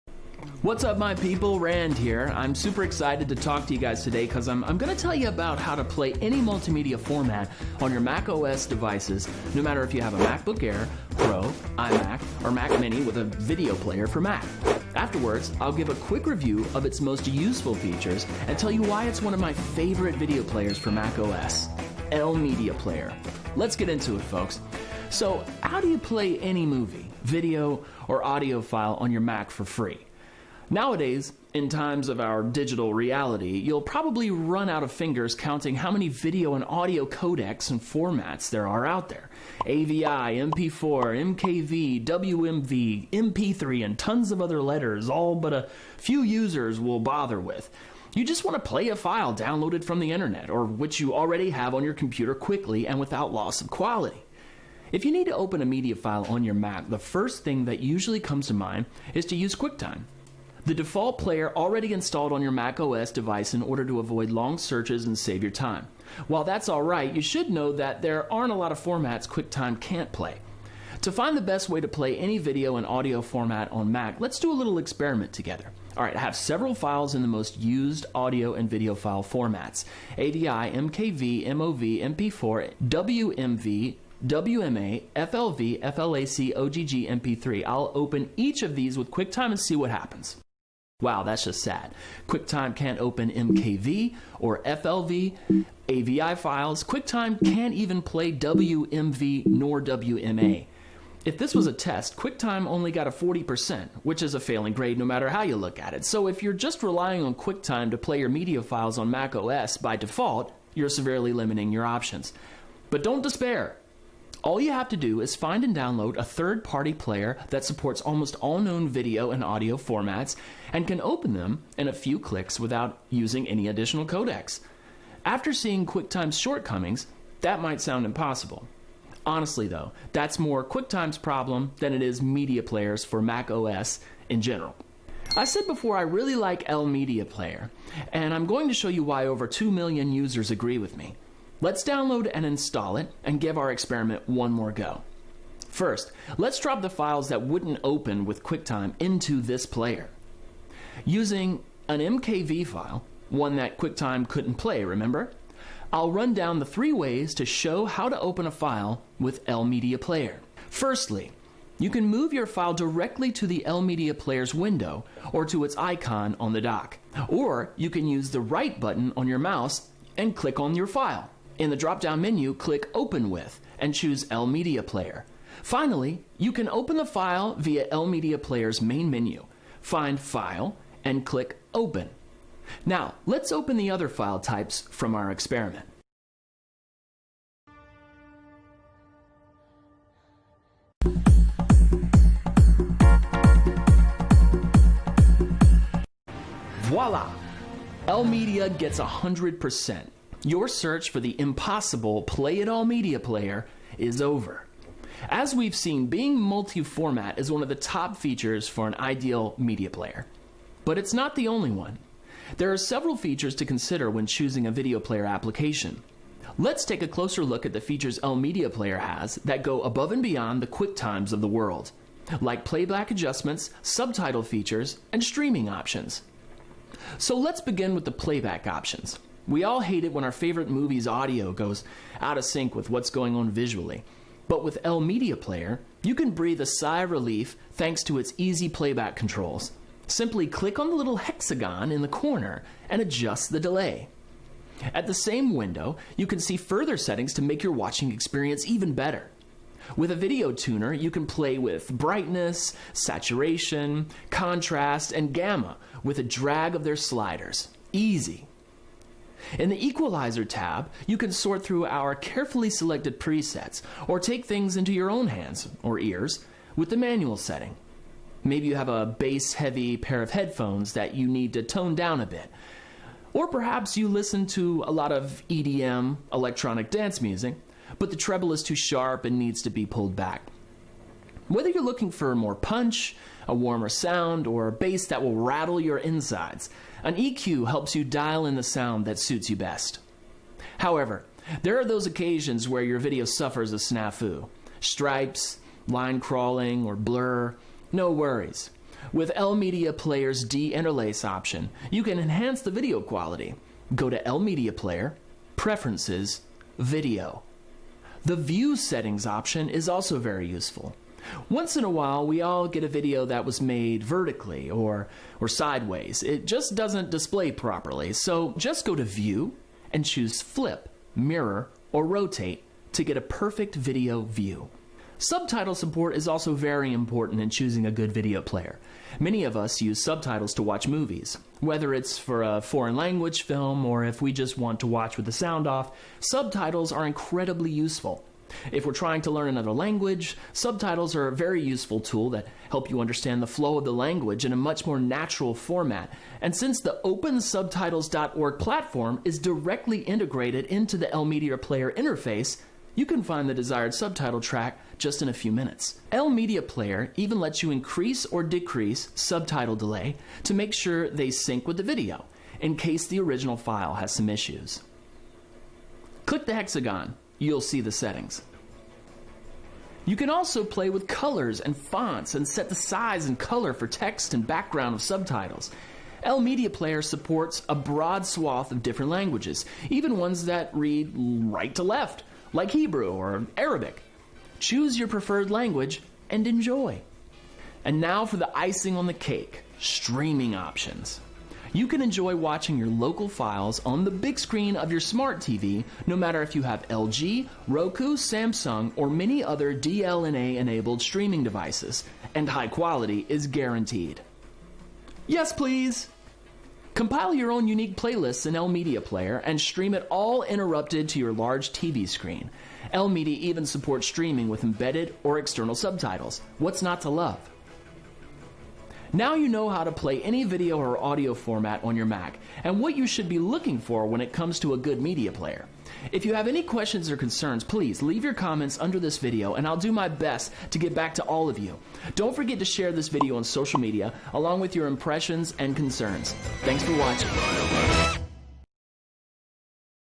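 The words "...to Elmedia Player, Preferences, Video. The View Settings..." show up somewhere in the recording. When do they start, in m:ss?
5:04.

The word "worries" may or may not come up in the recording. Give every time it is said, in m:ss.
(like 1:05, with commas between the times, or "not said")
4:58.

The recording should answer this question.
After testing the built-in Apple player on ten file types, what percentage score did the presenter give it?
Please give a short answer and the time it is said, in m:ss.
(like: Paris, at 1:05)
40%, at 1:43.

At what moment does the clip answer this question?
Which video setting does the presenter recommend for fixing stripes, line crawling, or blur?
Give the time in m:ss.
5:00.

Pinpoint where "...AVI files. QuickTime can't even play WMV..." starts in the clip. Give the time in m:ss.
1:35.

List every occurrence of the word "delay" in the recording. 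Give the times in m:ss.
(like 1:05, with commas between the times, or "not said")
4:03, 5:59.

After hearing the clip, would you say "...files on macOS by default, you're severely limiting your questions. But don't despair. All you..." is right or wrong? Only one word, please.
wrong.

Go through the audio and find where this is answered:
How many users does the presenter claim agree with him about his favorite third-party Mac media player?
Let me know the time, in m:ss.
2:19.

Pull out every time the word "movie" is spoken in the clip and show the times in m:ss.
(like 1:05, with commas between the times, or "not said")
0:26, 3:50, 5:30.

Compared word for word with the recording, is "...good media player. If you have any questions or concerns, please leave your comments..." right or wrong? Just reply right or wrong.
right.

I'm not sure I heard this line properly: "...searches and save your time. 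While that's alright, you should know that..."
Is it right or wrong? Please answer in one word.
right.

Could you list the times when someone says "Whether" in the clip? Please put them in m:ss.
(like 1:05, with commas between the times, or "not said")
4:41, 5:31.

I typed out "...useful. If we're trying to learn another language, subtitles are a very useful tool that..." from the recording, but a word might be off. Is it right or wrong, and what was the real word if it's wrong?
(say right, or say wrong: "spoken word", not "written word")
right.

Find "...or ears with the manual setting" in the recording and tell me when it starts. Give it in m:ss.
4:25.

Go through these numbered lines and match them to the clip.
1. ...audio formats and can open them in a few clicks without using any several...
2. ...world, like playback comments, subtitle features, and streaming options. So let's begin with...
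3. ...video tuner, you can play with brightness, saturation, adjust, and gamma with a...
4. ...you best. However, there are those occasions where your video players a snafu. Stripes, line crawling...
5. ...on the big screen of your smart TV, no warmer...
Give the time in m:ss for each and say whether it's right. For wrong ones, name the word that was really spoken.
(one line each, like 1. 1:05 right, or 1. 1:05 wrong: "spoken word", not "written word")
1. 1:59 wrong: "additional", not "several"
2. 3:41 wrong: "adjustments", not "comments"
3. 4:10 wrong: "contrast", not "adjust"
4. 4:49 wrong: "suffers", not "players"
5. 6:33 wrong: "matter", not "warmer".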